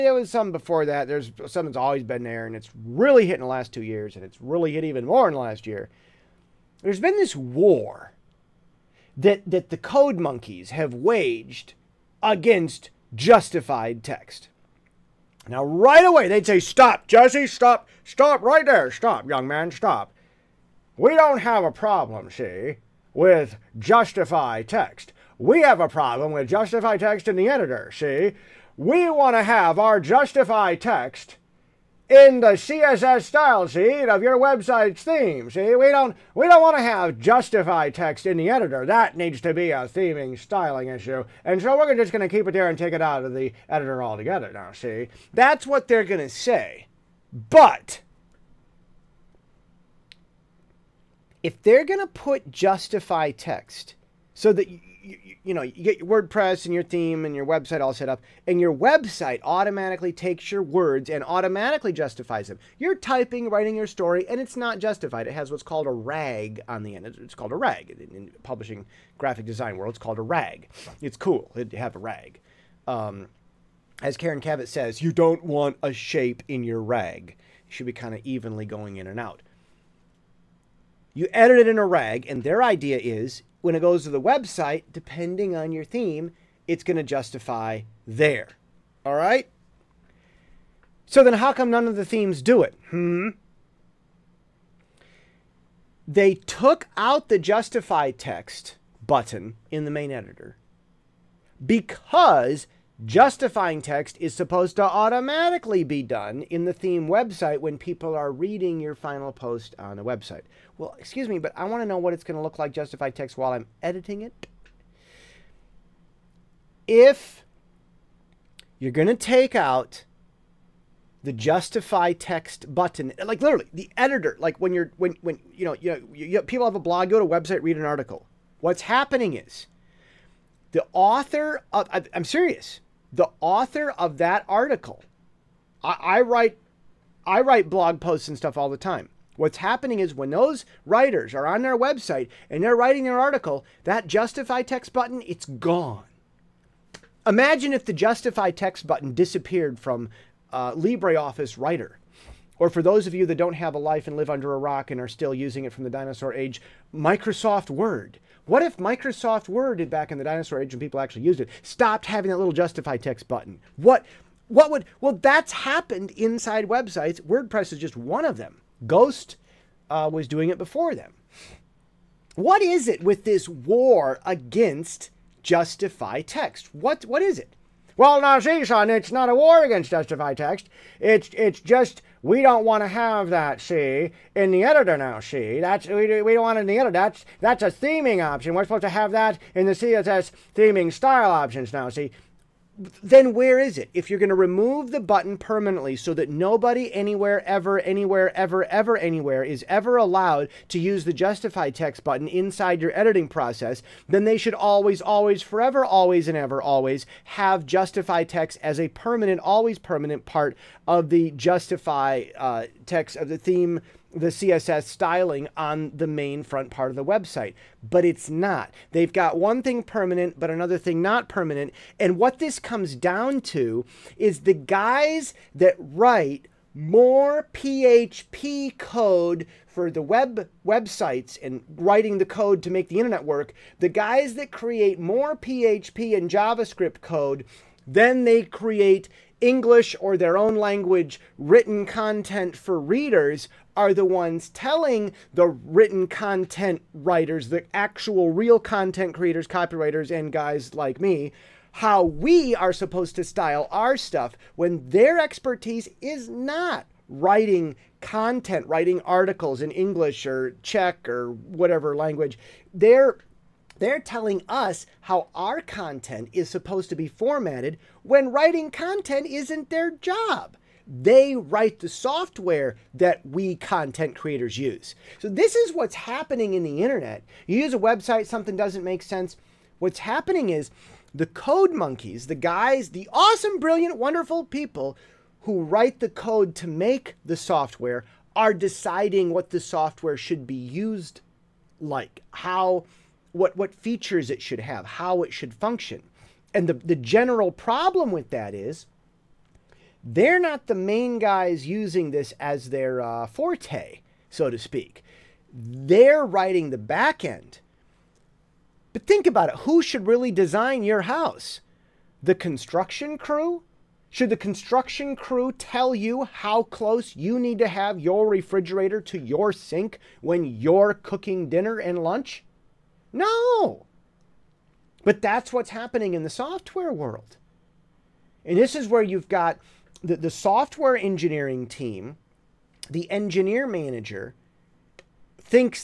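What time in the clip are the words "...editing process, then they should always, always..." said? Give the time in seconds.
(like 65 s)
202 s.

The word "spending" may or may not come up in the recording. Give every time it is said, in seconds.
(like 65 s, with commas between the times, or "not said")
not said.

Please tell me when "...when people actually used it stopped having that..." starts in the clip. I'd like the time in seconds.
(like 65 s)
160 s.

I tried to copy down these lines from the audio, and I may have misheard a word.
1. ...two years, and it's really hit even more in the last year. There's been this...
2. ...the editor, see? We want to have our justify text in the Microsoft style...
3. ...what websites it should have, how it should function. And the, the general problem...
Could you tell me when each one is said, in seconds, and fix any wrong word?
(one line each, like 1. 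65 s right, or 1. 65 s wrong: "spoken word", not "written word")
1. 3 s right
2. 27 s wrong: "CSS", not "Microsoft"
3. 293 s wrong: "features", not "websites".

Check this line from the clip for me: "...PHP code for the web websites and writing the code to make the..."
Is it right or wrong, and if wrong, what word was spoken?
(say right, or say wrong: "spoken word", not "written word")
right.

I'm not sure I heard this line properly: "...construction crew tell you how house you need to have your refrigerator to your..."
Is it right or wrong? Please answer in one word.
wrong.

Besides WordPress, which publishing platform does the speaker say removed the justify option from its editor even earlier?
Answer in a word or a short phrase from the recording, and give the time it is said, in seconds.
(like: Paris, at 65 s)
Ghost, at 168 s.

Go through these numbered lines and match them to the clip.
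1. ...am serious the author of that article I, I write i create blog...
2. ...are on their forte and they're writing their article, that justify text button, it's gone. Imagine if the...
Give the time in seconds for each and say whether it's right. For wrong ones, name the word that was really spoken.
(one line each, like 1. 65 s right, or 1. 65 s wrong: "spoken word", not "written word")
1. 132 s wrong: "write", not "create"
2. 141 s wrong: "website", not "forte".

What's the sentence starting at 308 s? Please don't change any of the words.
But think about it who should really design your house?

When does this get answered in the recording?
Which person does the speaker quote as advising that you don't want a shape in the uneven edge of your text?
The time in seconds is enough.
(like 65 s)
74 s.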